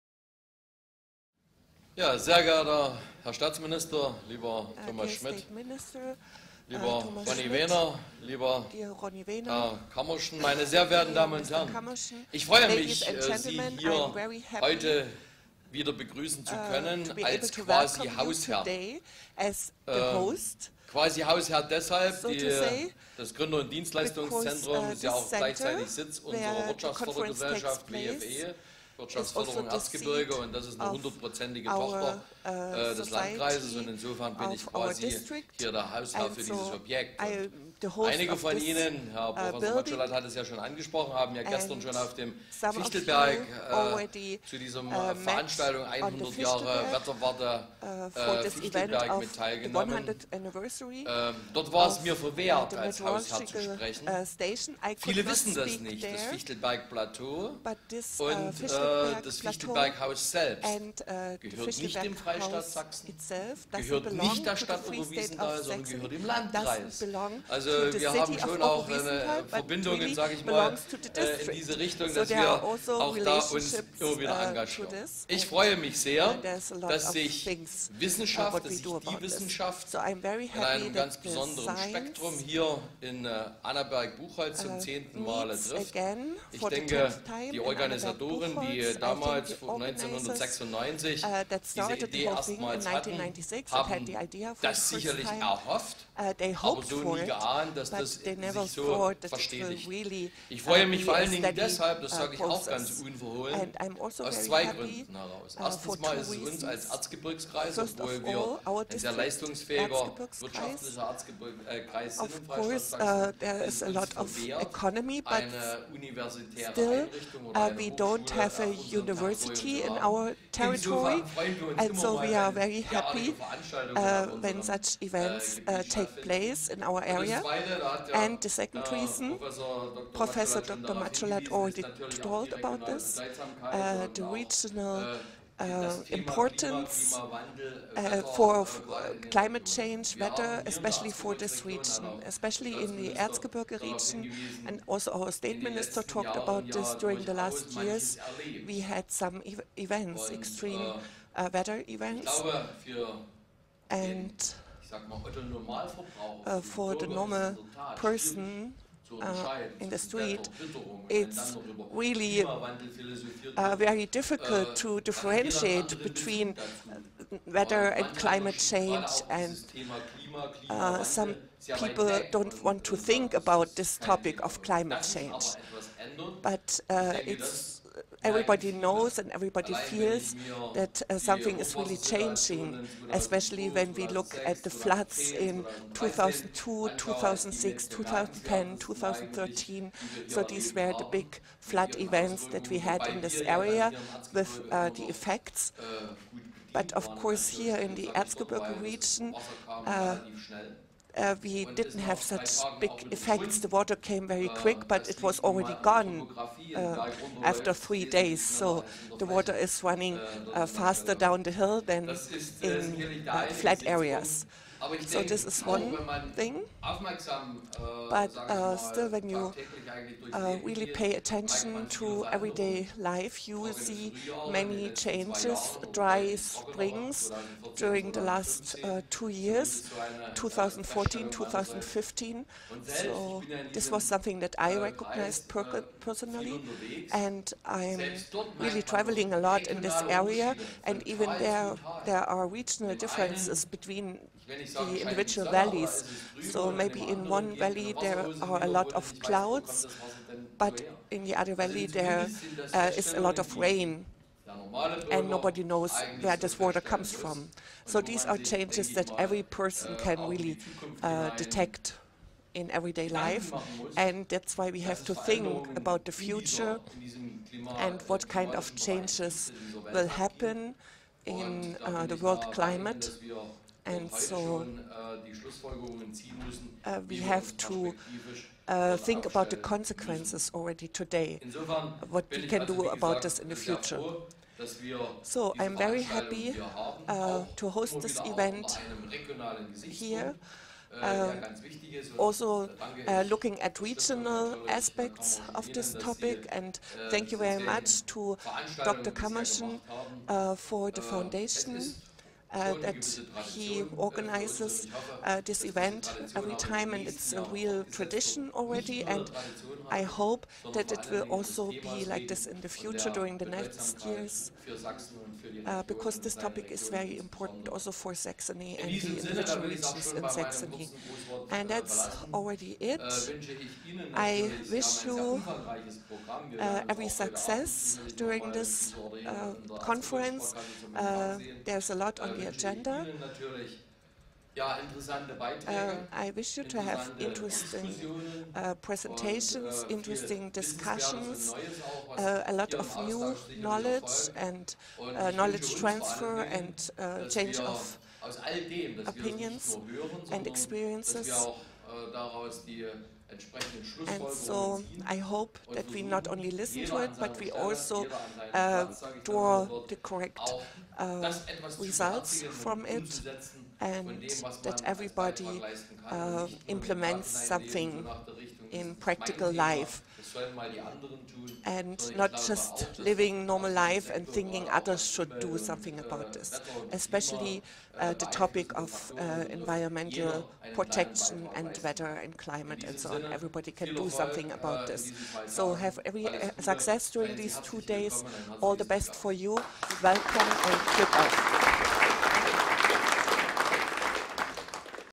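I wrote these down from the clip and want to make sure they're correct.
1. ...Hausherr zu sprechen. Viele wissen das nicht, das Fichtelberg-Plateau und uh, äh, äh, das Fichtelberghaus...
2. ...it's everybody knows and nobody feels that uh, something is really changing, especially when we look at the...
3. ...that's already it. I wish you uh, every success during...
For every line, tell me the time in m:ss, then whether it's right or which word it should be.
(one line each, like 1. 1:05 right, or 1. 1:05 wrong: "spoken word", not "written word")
1. 0:53 right
2. 2:57 wrong: "everybody", not "nobody"
3. 5:21 right.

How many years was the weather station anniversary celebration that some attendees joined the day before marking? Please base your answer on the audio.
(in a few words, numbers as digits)
100 years.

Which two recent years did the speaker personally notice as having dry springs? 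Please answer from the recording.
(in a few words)
2014 and 2015.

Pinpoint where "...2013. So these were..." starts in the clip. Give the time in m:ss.
3:08.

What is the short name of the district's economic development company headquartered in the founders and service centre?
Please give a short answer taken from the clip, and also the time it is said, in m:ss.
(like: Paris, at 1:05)
WFE, at 0:27.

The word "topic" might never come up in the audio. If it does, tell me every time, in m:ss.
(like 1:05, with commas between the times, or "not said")
2:53, 4:55, 5:16, 6:18.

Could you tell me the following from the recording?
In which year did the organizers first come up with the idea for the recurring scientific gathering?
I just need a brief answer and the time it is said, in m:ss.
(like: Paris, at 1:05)
1996, at 1:29.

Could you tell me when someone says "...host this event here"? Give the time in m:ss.
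4:47.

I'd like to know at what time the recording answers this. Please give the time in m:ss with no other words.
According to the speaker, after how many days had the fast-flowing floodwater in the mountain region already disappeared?
3:27.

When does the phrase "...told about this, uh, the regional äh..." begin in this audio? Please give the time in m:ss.
2:12.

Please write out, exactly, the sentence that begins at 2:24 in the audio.
And also our state minister talked about this during the last years.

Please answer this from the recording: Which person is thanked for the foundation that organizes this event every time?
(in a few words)
Dr. Kammerschen.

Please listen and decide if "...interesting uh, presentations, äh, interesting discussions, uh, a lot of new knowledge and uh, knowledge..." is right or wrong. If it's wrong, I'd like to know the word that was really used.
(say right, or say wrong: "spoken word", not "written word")
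right.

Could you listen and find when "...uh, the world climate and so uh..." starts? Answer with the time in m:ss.
4:31.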